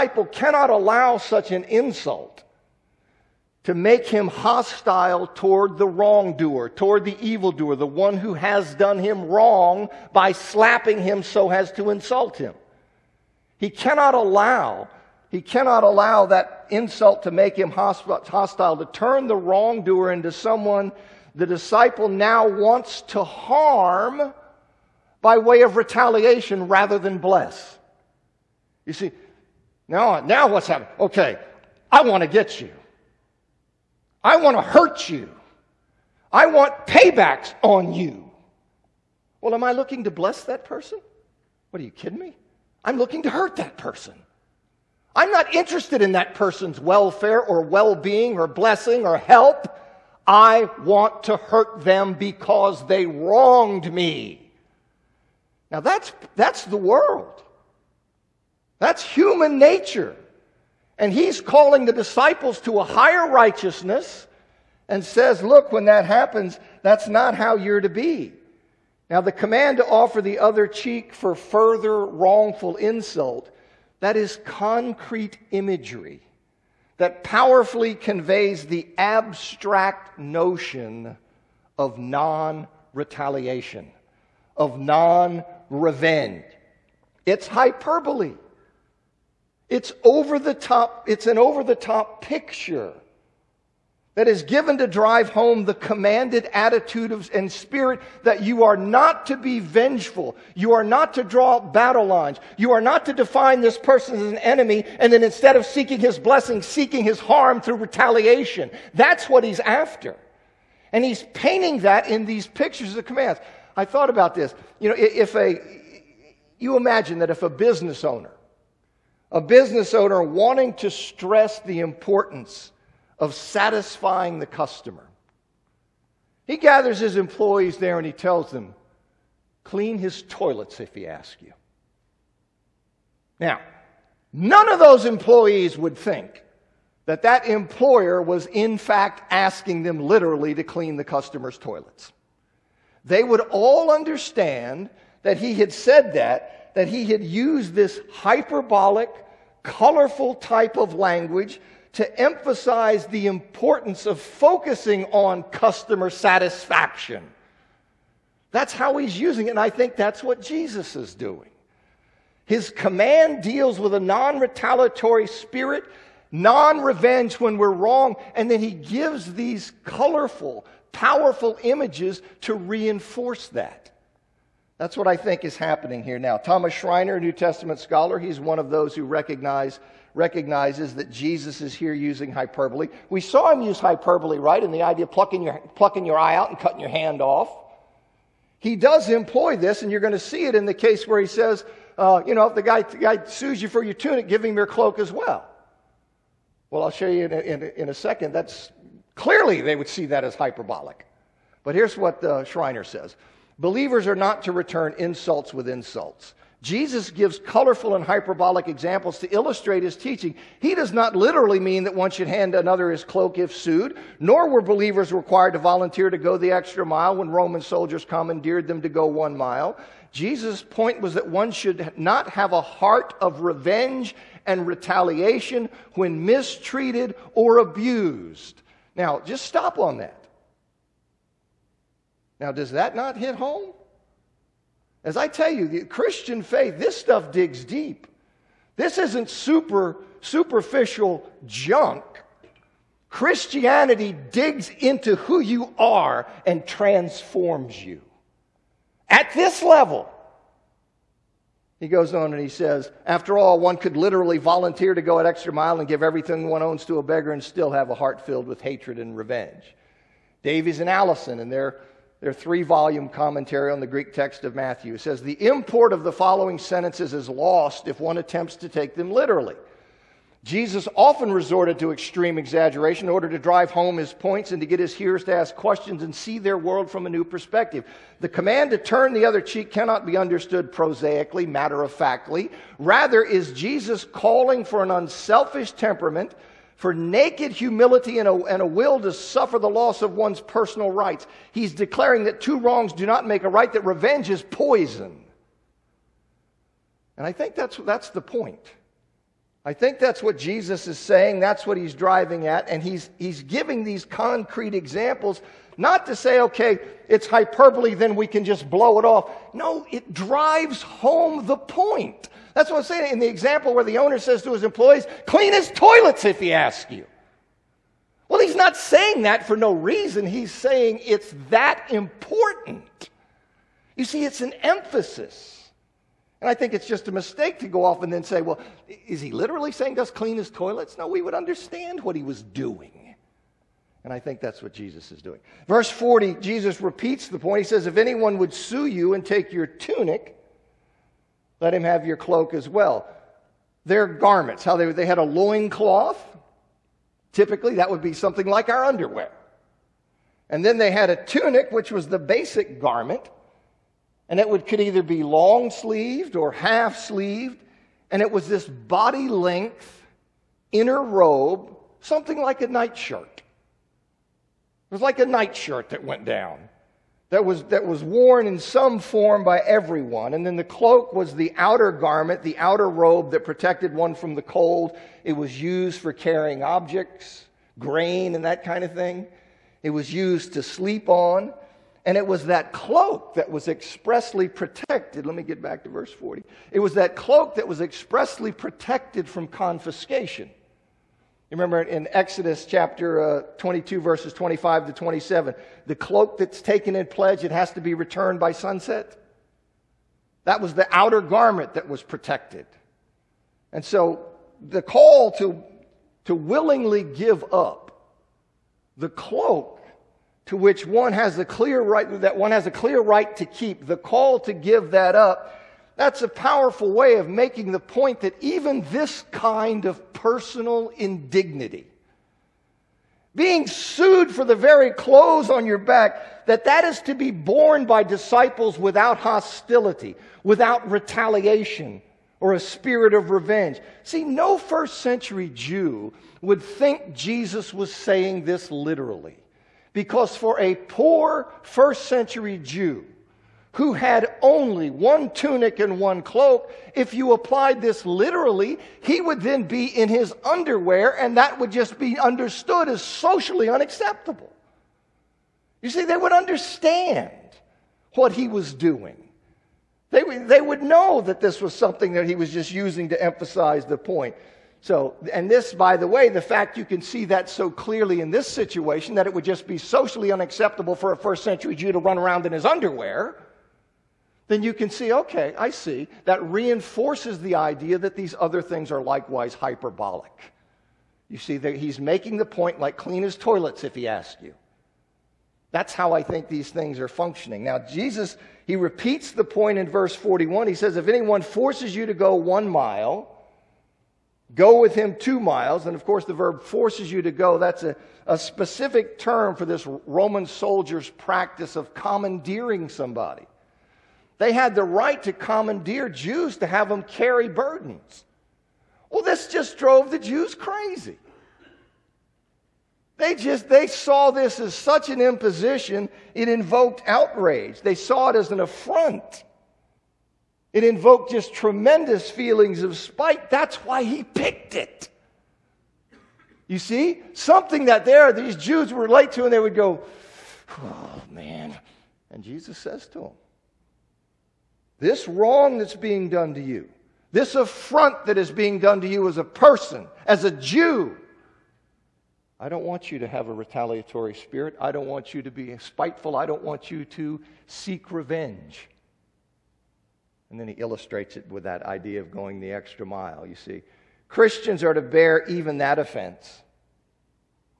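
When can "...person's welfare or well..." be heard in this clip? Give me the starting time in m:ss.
0:46.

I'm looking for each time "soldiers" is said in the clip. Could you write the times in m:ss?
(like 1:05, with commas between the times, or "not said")
3:37, 8:20.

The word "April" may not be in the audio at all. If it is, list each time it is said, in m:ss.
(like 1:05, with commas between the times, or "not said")
not said.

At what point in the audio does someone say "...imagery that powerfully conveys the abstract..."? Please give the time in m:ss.
1:15.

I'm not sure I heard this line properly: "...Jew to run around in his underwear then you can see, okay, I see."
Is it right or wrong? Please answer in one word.
right.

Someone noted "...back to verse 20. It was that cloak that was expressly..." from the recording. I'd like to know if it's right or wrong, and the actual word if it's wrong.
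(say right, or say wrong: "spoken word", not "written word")
wrong: "40", not "20".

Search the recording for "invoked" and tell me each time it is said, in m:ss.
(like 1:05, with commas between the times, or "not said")
8:36, 8:40.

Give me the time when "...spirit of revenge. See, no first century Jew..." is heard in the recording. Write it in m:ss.
7:12.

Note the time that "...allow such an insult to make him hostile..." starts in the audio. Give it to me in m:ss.
0:00.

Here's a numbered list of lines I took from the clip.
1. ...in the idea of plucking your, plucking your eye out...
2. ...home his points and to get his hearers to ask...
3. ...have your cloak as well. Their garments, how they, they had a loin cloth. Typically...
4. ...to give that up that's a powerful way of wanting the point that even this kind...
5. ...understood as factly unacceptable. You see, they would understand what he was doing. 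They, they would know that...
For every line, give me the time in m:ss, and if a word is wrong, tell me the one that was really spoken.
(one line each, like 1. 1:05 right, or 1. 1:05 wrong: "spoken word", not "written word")
1. 3:04 right
2. 4:33 right
3. 5:41 right
4. 6:54 wrong: "making", not "wanting"
5. 7:32 wrong: "socially", not "factly".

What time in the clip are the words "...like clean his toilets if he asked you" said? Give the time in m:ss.
8:02.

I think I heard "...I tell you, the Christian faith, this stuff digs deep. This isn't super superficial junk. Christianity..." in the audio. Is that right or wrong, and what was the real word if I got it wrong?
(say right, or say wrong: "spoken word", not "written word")
right.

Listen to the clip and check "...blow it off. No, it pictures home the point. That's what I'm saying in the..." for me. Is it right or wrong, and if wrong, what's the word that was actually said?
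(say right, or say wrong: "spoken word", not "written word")
wrong: "drives", not "pictures".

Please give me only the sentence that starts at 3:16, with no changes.
Well, I'll show you in a, in a, in a second.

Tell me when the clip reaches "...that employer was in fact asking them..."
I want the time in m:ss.
2:17.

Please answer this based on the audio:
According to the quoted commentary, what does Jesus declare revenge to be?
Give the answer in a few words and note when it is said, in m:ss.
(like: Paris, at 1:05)
Poison, at 4:54.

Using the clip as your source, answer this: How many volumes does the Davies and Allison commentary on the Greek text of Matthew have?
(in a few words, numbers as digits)
3.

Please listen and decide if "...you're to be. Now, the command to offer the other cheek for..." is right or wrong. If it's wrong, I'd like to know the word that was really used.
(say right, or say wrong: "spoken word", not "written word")
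right.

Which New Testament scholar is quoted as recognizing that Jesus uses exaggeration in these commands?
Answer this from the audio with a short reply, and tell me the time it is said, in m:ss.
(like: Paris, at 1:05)
Thomas Schreiner, at 2:56.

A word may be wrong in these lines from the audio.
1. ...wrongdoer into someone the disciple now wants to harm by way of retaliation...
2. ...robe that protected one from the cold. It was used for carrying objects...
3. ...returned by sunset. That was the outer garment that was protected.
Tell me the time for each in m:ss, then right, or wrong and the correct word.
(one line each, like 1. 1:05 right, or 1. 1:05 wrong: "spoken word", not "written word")
1. 0:19 right
2. 6:12 right
3. 6:37 right.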